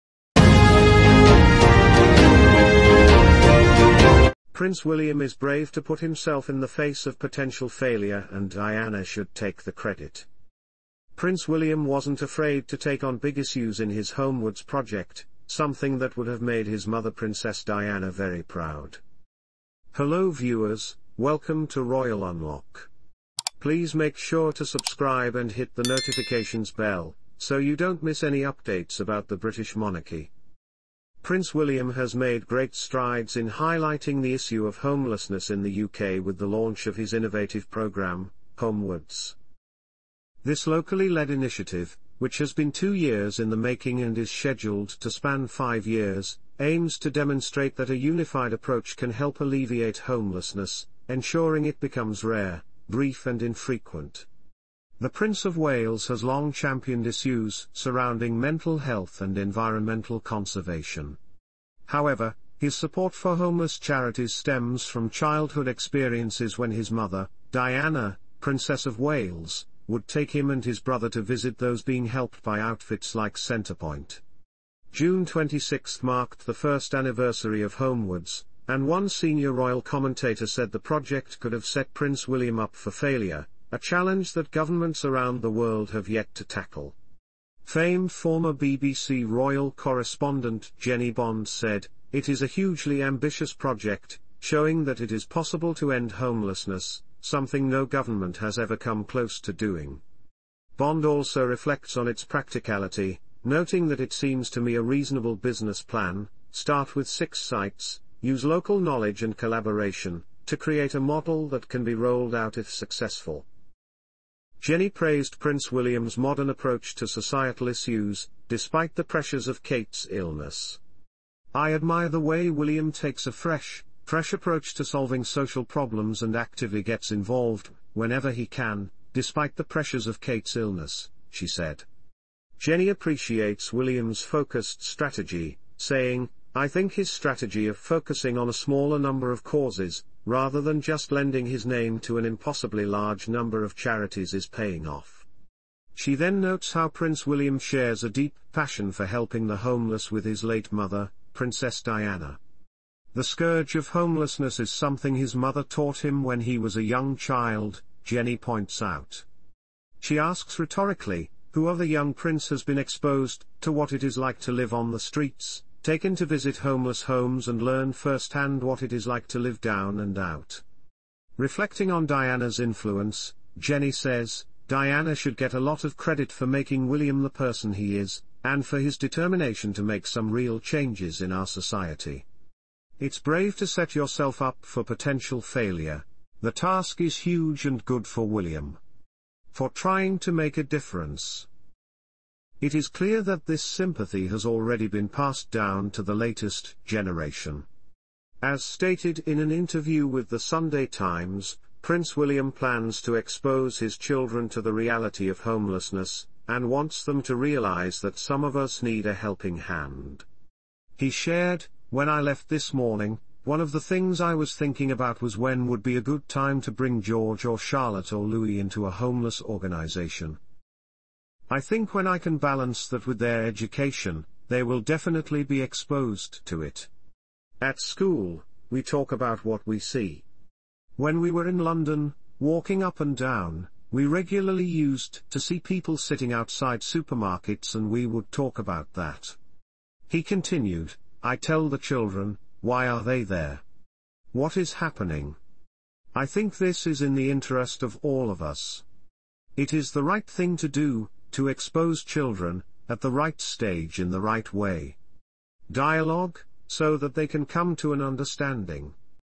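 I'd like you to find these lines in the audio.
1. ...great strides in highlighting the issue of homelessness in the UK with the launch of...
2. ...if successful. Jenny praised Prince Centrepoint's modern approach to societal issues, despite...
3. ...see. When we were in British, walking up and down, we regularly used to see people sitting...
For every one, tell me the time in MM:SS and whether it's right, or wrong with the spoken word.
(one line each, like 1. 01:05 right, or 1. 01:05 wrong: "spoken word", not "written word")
1. 00:32 right
2. 01:52 wrong: "William", not "Centrepoint"
3. 03:49 wrong: "London", not "British".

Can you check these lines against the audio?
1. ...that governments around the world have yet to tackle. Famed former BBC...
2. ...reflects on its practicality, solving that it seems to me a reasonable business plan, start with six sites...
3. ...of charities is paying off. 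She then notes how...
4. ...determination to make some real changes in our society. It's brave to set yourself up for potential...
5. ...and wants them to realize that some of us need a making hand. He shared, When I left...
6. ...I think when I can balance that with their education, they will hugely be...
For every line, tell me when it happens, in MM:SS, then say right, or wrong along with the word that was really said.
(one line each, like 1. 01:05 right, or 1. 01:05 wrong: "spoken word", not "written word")
1. 01:24 right
2. 01:41 wrong: "noting", not "solving"
3. 02:23 right
4. 02:58 right
5. 03:26 wrong: "helping", not "making"
6. 03:41 wrong: "definitely", not "hugely".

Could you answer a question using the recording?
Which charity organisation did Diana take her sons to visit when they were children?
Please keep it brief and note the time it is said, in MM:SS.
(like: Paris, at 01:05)
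Centrepoint, at 01:13.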